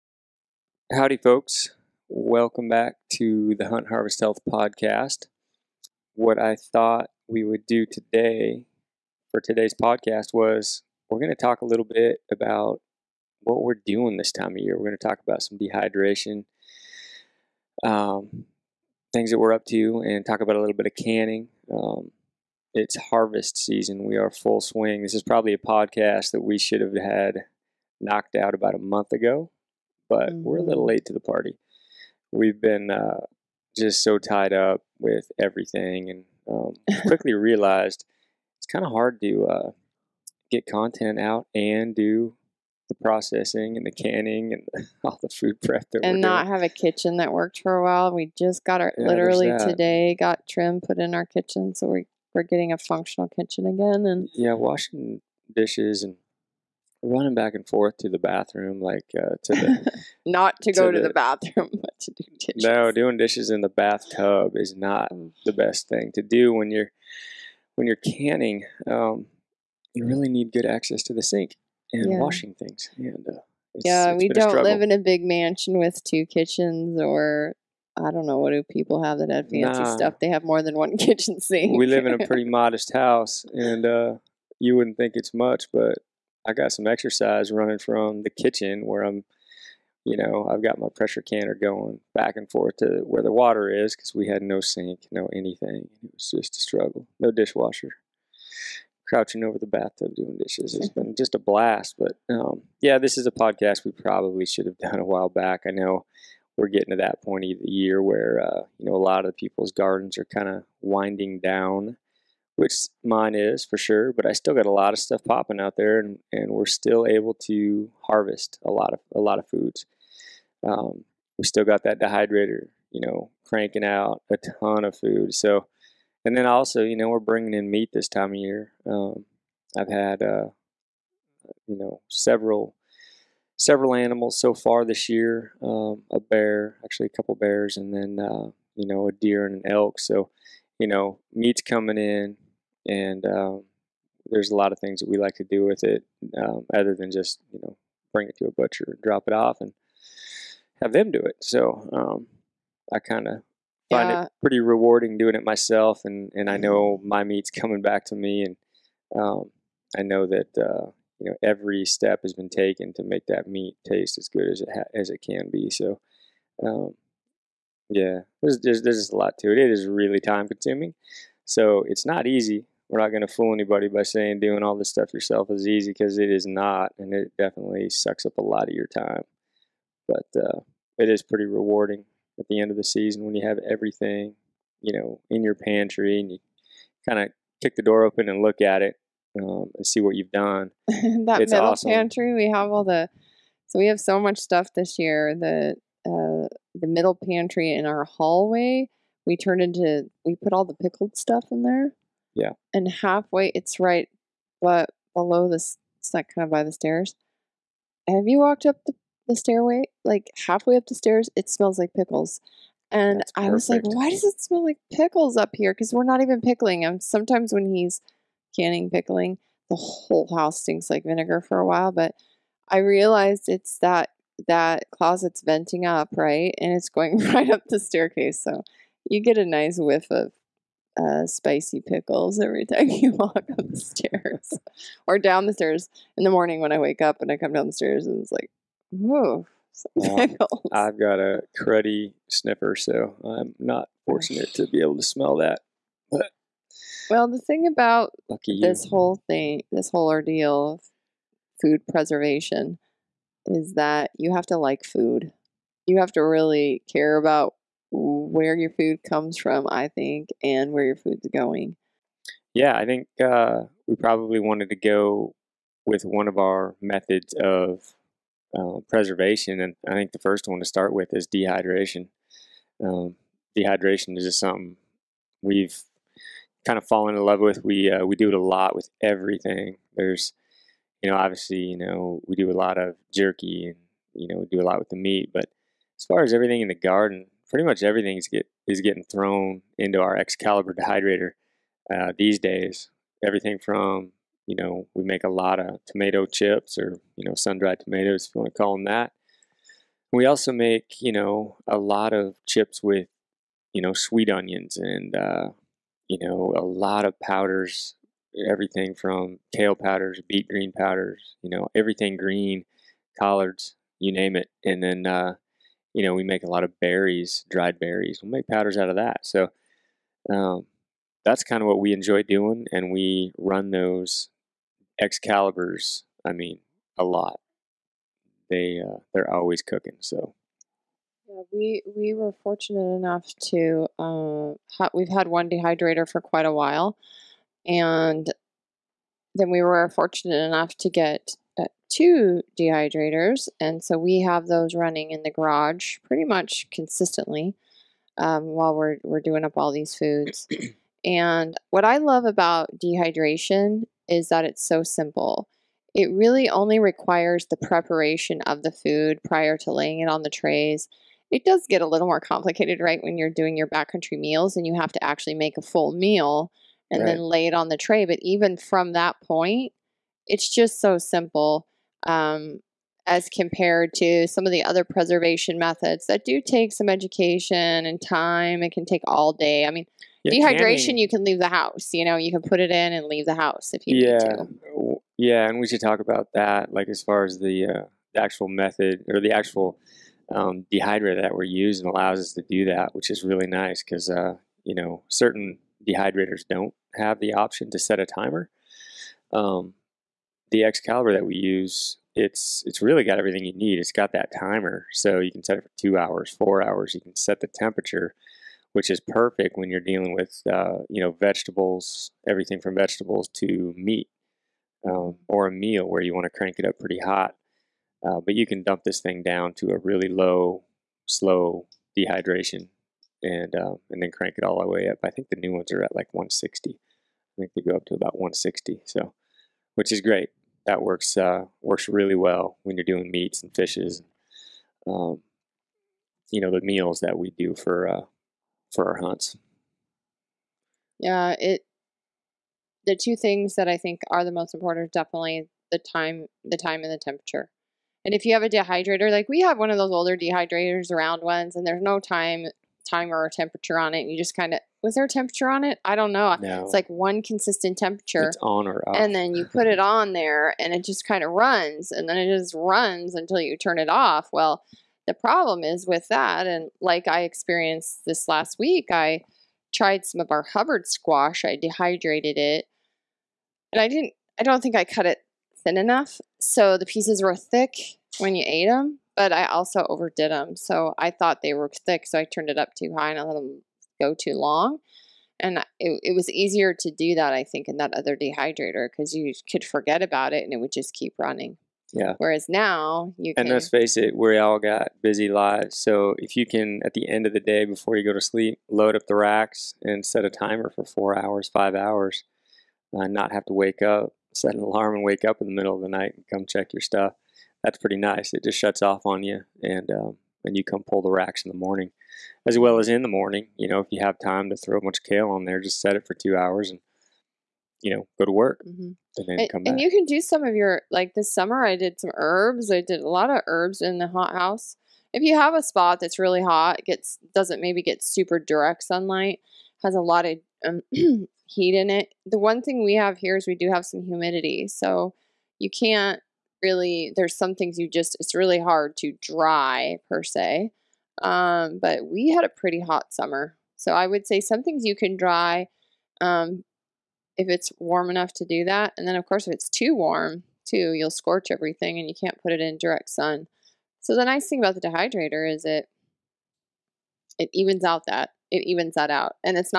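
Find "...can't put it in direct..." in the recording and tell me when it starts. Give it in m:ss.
9:12.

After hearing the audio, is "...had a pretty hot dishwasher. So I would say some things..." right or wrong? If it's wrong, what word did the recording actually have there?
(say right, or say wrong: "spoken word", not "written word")
wrong: "summer", not "dishwasher".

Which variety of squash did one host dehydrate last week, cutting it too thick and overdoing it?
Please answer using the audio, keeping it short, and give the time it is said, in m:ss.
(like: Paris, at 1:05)
Hubbard squash, at 7:50.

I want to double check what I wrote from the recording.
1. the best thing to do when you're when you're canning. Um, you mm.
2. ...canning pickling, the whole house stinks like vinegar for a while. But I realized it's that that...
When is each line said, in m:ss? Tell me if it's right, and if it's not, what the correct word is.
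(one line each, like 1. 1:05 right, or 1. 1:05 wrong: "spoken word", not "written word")
1. 1:05 right
2. 3:38 right.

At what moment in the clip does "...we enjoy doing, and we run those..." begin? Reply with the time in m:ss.
5:21.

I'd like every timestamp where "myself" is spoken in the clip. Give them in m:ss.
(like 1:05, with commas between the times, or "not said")
2:35.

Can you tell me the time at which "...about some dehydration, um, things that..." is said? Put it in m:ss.
0:15.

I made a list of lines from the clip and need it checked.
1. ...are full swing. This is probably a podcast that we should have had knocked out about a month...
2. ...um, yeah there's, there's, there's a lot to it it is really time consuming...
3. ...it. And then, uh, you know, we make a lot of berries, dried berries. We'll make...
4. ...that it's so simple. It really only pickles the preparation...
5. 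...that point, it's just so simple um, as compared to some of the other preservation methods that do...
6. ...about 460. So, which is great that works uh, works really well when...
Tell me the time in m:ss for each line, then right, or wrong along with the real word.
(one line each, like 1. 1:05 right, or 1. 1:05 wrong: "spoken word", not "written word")
1. 0:24 right
2. 2:46 right
3. 5:14 right
4. 5:54 wrong: "requires", not "pickles"
5. 6:08 right
6. 7:07 wrong: "160", not "460".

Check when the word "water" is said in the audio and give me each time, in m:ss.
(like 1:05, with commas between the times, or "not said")
1:33.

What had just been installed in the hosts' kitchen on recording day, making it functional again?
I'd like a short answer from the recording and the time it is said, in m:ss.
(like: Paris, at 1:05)
Trim, at 0:50.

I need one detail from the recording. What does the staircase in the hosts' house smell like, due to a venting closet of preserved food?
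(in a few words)
Spicy pickles.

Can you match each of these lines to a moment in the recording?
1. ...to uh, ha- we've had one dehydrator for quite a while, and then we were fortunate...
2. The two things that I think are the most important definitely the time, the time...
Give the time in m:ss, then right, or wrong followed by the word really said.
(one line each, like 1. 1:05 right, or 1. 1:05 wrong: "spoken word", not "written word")
1. 5:33 right
2. 7:22 right.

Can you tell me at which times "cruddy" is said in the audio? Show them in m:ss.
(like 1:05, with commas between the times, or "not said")
4:01.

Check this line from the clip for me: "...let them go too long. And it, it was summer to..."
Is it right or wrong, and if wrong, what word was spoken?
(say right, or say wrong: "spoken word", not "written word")
wrong: "easier", not "summer".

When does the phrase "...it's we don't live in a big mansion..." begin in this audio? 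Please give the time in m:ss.
1:14.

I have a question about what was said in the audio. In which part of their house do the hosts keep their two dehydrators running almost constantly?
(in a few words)
The garage.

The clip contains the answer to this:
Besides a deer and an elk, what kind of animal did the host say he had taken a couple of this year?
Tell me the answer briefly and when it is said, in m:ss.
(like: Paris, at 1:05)
Bears, at 2:17.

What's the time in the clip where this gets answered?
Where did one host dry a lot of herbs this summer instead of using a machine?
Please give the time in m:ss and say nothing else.
8:44.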